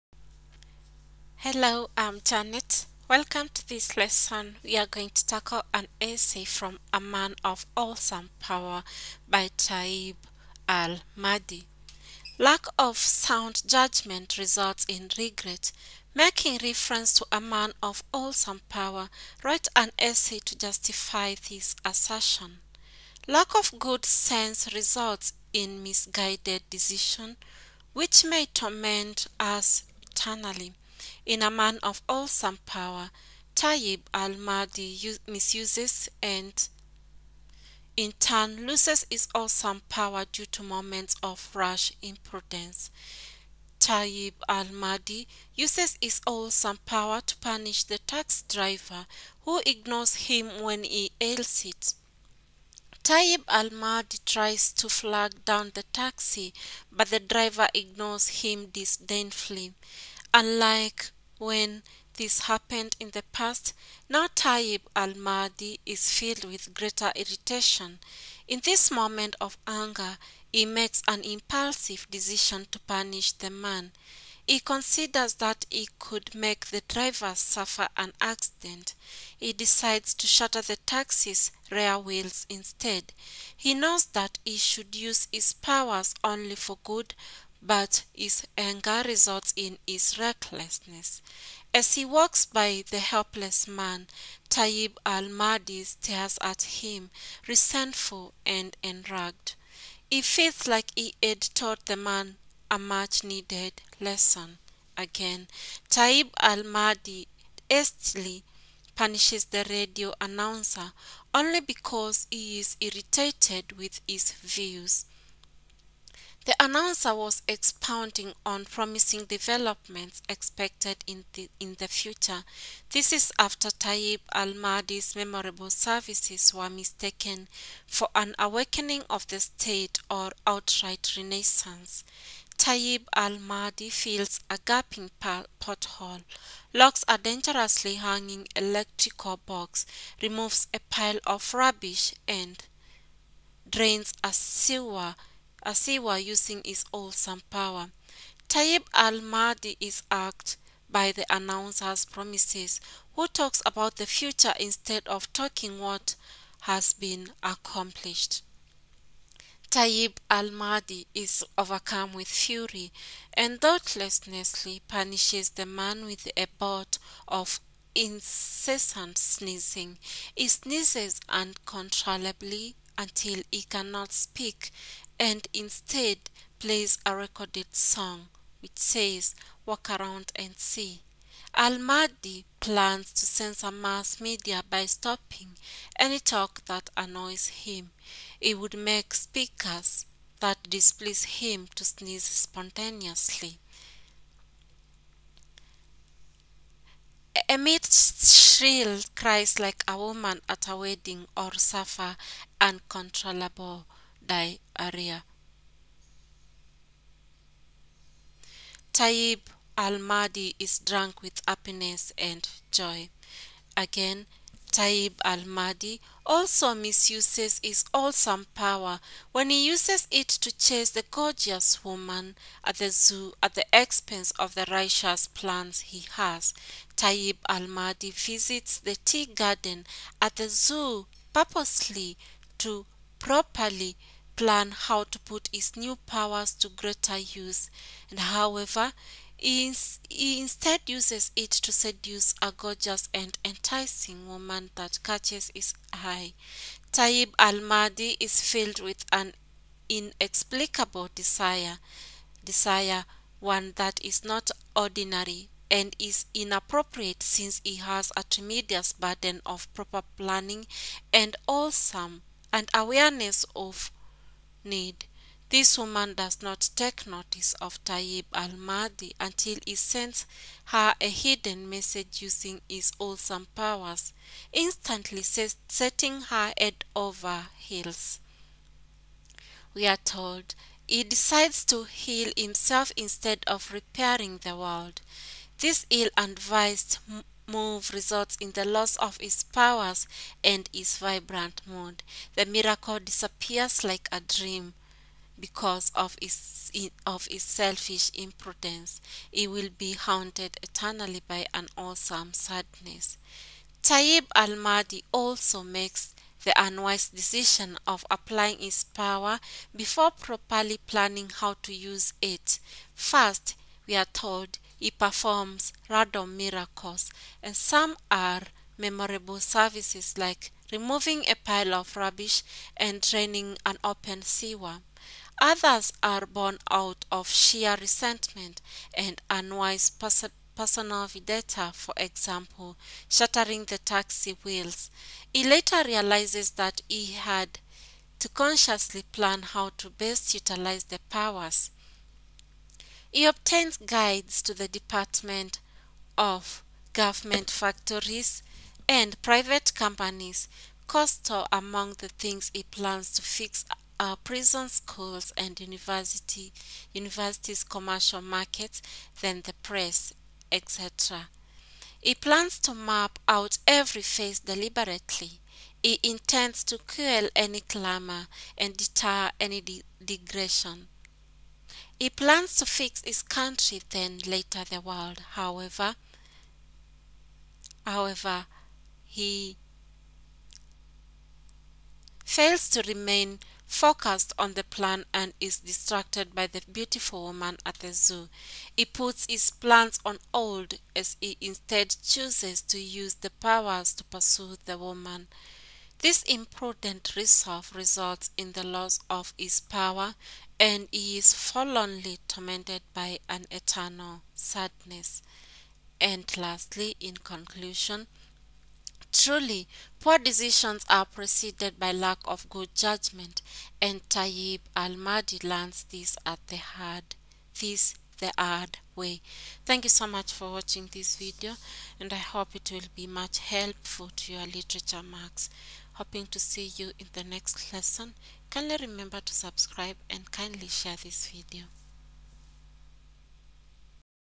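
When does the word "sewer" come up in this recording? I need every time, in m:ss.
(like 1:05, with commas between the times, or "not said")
2:24, 5:24.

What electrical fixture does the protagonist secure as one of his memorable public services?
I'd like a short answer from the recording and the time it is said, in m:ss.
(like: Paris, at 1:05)
electrical box, at 2:18.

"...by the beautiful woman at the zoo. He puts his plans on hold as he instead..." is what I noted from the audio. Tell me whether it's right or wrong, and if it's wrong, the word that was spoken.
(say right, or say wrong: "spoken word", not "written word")
right.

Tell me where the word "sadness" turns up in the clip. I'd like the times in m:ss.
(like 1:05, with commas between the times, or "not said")
5:02, 6:44.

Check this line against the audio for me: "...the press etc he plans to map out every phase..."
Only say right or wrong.
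right.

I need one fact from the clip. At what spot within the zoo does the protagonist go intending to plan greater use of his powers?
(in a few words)
tea garden.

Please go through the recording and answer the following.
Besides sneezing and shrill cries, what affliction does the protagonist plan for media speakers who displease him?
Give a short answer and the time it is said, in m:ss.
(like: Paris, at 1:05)
uncontrollable diarrhea, at 3:22.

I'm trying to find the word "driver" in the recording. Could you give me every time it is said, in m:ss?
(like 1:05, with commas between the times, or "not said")
0:48, 0:57, 1:16.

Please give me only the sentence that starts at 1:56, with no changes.
The announcer was expounding on promising developments expected in the, in the future.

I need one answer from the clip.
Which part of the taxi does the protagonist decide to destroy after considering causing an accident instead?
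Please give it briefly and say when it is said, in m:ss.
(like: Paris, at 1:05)
rear wheels, at 1:21.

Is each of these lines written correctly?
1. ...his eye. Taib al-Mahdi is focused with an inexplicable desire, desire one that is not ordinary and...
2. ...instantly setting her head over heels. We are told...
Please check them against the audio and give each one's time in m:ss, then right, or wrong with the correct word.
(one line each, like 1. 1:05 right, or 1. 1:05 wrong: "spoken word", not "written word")
1. 4:05 wrong: "filled", not "focused"
2. 4:34 right.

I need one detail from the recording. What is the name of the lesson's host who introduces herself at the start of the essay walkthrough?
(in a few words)
Janet.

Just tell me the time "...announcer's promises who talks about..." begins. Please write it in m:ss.
2:31.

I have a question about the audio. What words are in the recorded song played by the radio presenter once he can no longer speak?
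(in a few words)
walk around and see.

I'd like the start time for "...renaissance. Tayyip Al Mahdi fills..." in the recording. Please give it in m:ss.
2:11.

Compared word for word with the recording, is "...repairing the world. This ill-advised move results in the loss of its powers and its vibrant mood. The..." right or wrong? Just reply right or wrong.
right.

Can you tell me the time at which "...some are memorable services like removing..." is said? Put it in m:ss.
5:17.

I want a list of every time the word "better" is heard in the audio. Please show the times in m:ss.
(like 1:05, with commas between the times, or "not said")
not said.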